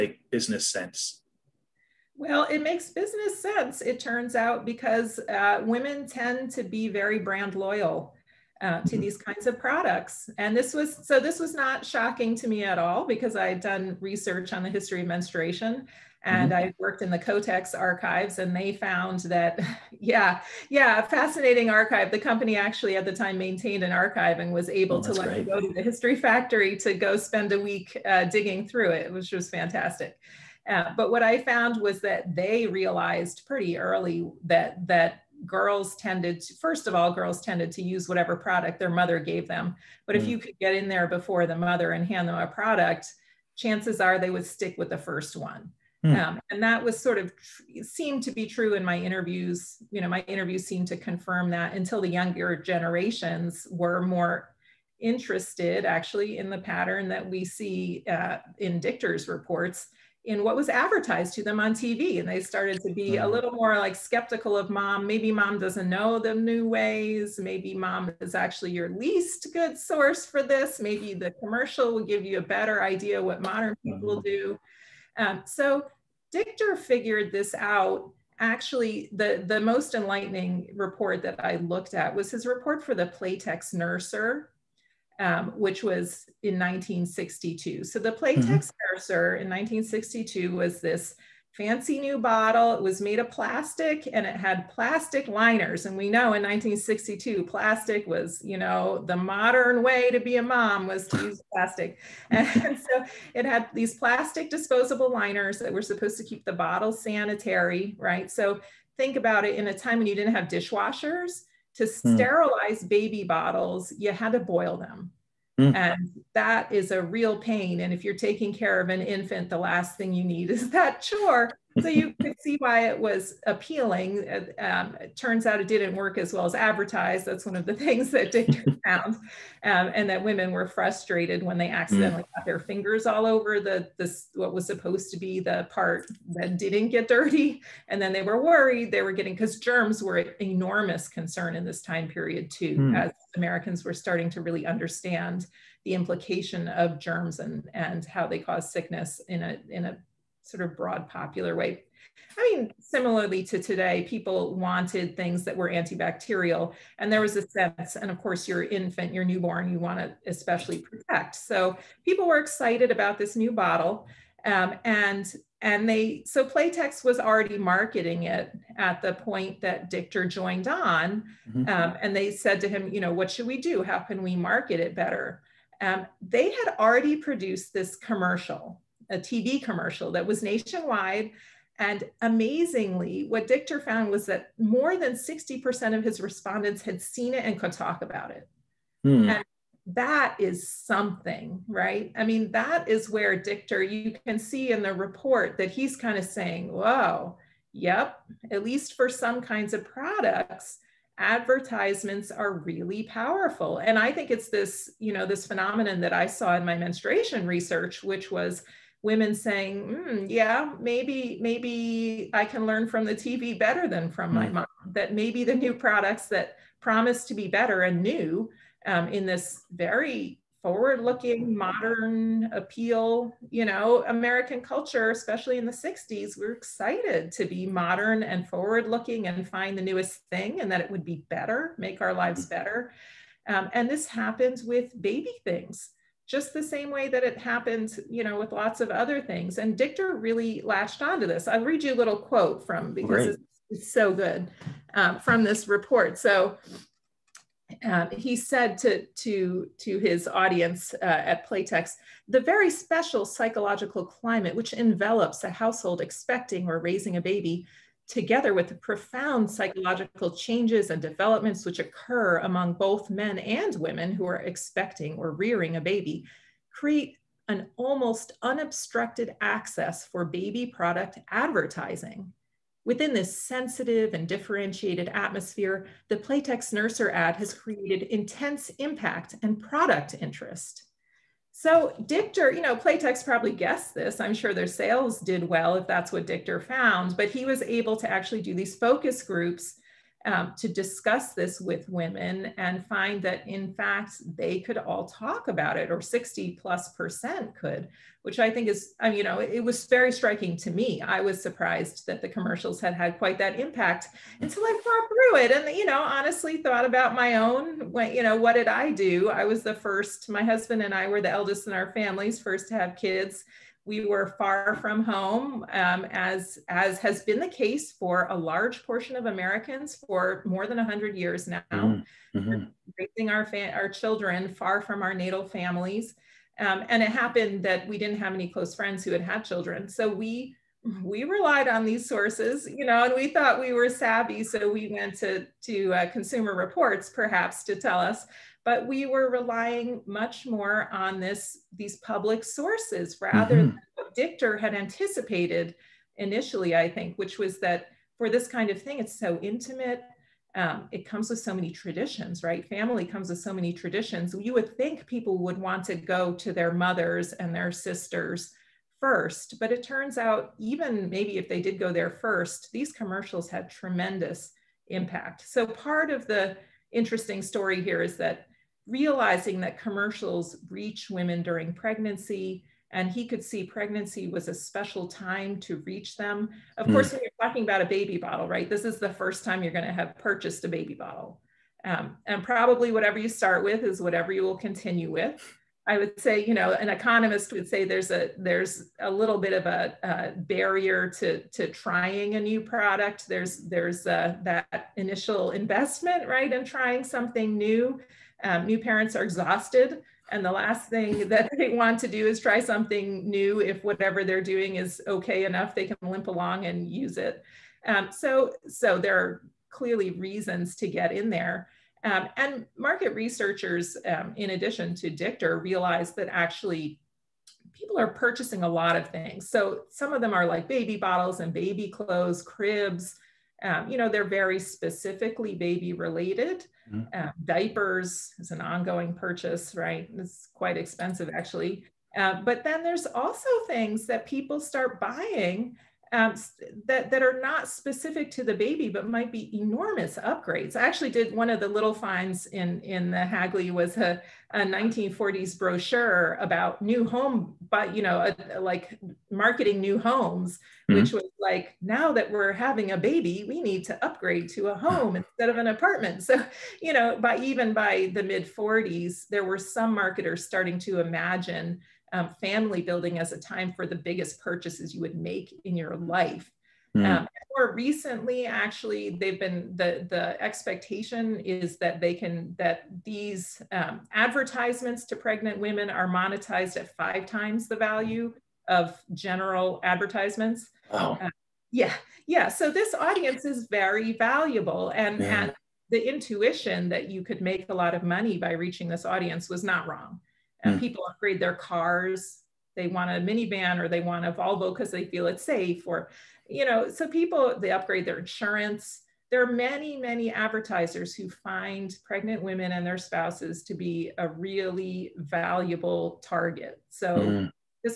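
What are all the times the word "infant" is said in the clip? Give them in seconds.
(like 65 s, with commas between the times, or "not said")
119 s, 158 s.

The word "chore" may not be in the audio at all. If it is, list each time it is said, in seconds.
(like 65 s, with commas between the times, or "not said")
121 s.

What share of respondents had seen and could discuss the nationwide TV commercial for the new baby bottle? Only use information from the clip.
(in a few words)
more than 60%.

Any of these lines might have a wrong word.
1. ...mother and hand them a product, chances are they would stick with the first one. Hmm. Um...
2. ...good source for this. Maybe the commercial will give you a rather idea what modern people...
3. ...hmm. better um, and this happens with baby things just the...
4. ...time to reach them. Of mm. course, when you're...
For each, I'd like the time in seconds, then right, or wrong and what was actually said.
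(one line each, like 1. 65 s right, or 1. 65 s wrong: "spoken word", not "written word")
1. 41 s right
2. 69 s wrong: "better", not "rather"
3. 232 s right
4. 375 s right.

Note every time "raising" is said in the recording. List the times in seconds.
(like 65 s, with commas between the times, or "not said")
256 s, 322 s.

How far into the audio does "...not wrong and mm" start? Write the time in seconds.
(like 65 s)
489 s.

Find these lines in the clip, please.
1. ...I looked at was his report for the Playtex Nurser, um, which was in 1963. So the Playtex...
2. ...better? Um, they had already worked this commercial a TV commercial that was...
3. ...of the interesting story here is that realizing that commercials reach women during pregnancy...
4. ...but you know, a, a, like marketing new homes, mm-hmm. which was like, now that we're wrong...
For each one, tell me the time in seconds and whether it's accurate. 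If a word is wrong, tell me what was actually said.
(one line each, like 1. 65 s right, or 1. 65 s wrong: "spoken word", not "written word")
1. 81 s wrong: "1962", not "1963"
2. 174 s wrong: "produced", not "worked"
3. 366 s right
4. 447 s wrong: "having", not "wrong".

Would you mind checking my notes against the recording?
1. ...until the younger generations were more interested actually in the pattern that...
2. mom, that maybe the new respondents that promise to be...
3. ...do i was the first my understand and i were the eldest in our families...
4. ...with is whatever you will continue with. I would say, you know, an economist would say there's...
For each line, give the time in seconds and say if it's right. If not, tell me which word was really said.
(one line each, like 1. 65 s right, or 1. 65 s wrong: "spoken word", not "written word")
1. 51 s right
2. 214 s wrong: "products", not "respondents"
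3. 308 s wrong: "husband", not "understand"
4. 383 s right.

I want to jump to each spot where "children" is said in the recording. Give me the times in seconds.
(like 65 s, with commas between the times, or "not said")
323 s, 329 s.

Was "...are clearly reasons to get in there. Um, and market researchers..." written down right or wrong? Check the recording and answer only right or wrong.
right.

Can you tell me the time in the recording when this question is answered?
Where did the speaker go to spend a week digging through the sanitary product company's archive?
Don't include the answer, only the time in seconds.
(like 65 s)
25 s.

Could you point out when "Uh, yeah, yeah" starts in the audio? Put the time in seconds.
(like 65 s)
481 s.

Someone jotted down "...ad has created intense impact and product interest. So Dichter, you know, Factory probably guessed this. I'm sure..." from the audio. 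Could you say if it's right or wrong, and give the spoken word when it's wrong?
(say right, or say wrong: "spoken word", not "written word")
wrong: "Playtex", not "Factory".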